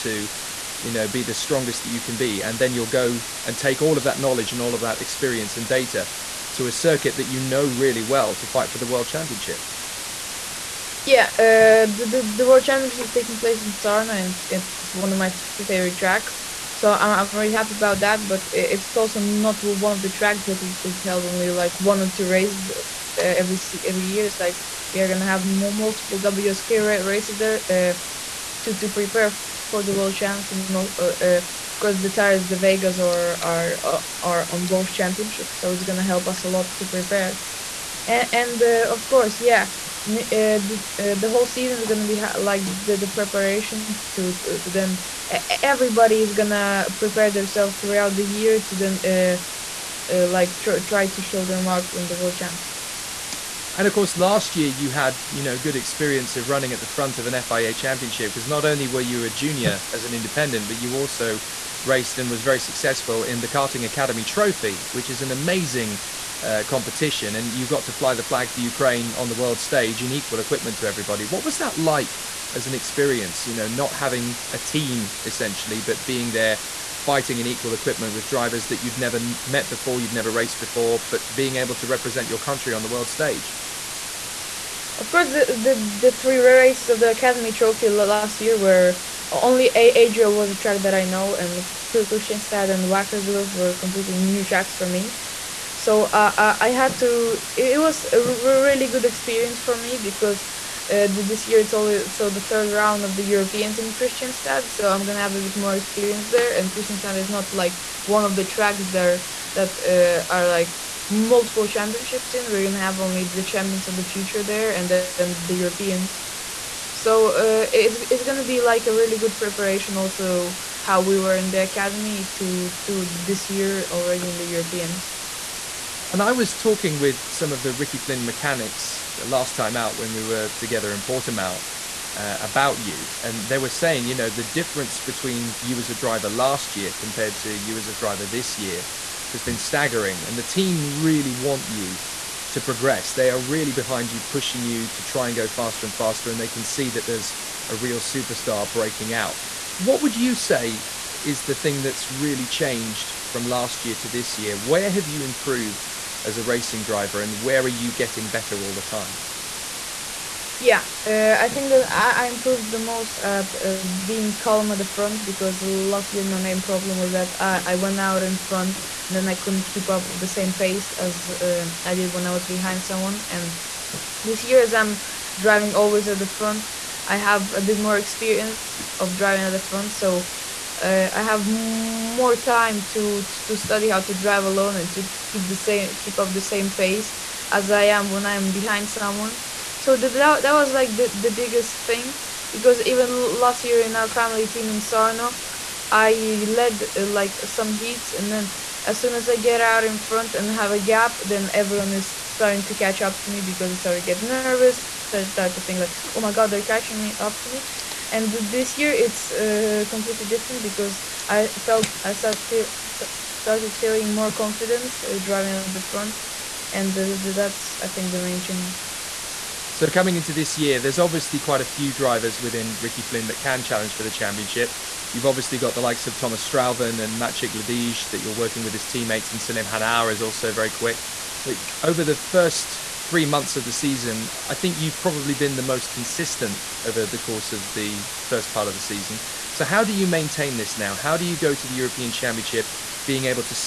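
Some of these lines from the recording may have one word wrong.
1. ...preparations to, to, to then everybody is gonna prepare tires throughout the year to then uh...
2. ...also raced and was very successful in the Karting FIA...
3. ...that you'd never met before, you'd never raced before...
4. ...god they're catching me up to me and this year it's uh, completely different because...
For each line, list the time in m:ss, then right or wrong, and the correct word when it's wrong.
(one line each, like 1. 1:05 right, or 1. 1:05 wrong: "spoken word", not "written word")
1. 0:43 wrong: "themselves", not "tires"
2. 1:00 wrong: "Academy", not "FIA"
3. 1:18 right
4. 3:26 right.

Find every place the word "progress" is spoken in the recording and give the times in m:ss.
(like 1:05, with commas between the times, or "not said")
2:22.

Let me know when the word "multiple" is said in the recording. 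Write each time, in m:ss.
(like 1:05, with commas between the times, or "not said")
0:25, 1:51.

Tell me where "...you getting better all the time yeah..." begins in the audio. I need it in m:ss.
2:37.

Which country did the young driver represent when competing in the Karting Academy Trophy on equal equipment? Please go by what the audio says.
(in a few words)
Ukraine.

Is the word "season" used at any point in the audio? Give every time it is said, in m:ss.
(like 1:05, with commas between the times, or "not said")
0:41, 3:53, 3:58.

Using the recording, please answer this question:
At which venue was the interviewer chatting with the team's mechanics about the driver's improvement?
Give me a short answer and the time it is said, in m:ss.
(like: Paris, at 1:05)
Portimao, at 2:11.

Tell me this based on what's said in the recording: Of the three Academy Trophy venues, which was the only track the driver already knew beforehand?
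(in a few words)
Adria.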